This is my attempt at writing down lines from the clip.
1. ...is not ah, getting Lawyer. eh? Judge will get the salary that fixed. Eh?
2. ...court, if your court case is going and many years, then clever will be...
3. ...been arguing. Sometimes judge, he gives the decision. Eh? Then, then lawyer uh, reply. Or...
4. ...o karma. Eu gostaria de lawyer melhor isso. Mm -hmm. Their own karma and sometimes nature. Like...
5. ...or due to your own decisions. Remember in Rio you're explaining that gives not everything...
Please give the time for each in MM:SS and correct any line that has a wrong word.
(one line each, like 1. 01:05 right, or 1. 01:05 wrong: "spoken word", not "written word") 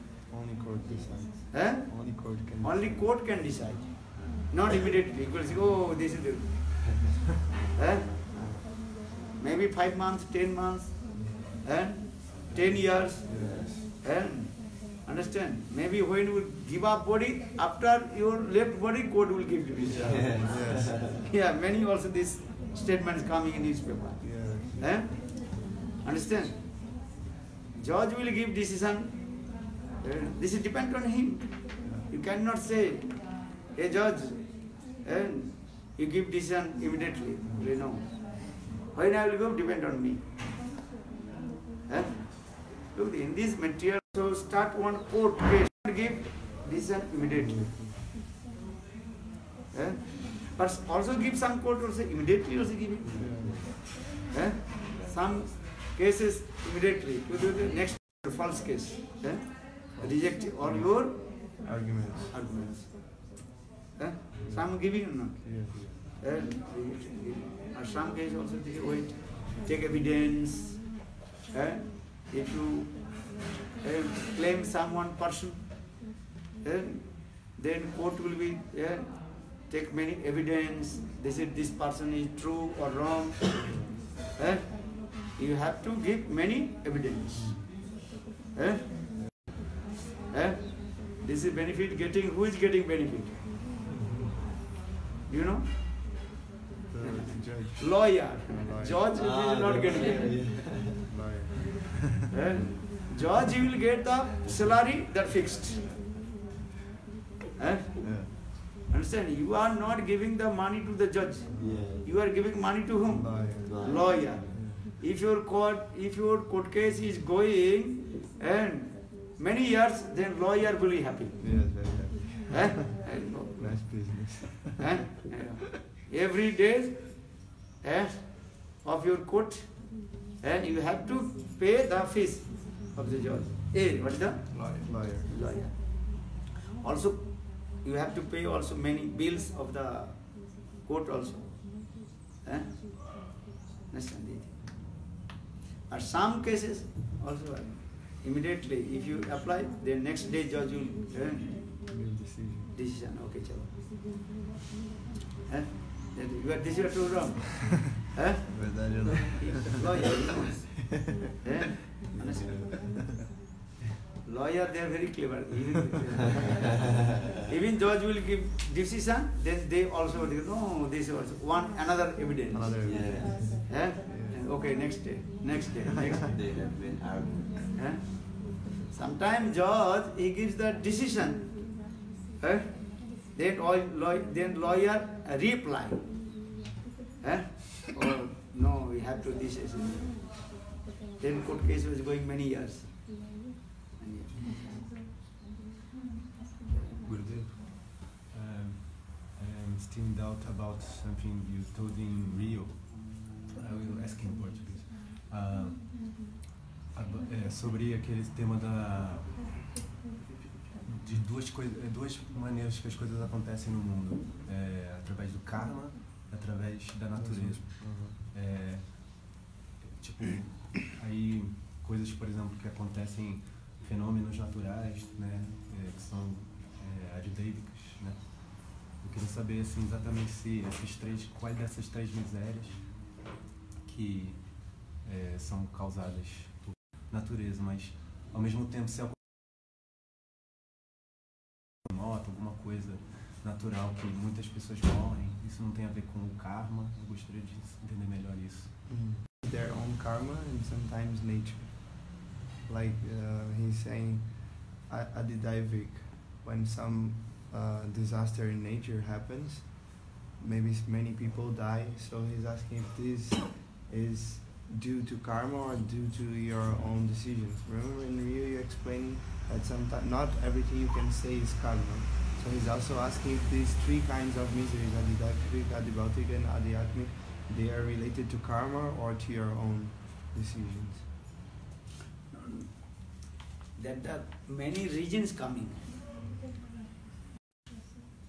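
1. 01:39 right
2. 01:55 wrong: "lawyer", not "clever"
3. 02:56 right
4. 04:06 wrong: "entender", not "lawyer"
5. 04:25 wrong: "sometimes", not "gives".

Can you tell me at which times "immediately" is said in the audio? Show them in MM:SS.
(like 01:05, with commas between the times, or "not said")
00:04, 00:36, 00:47, 00:52, 00:56, 02:28.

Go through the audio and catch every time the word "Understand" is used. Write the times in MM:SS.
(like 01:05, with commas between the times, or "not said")
00:15, 00:26, 01:48.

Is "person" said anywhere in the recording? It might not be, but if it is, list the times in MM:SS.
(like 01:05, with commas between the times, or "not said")
01:15, 01:21.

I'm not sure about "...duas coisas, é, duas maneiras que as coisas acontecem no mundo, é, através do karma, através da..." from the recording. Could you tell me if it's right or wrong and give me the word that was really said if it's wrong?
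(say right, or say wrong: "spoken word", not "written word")
right.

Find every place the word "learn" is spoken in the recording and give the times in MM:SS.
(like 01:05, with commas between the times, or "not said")
02:31.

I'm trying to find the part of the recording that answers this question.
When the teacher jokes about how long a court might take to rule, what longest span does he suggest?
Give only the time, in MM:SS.
00:12.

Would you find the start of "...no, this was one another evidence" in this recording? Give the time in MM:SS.
02:50.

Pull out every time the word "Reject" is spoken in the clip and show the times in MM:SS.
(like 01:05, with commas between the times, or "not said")
01:00.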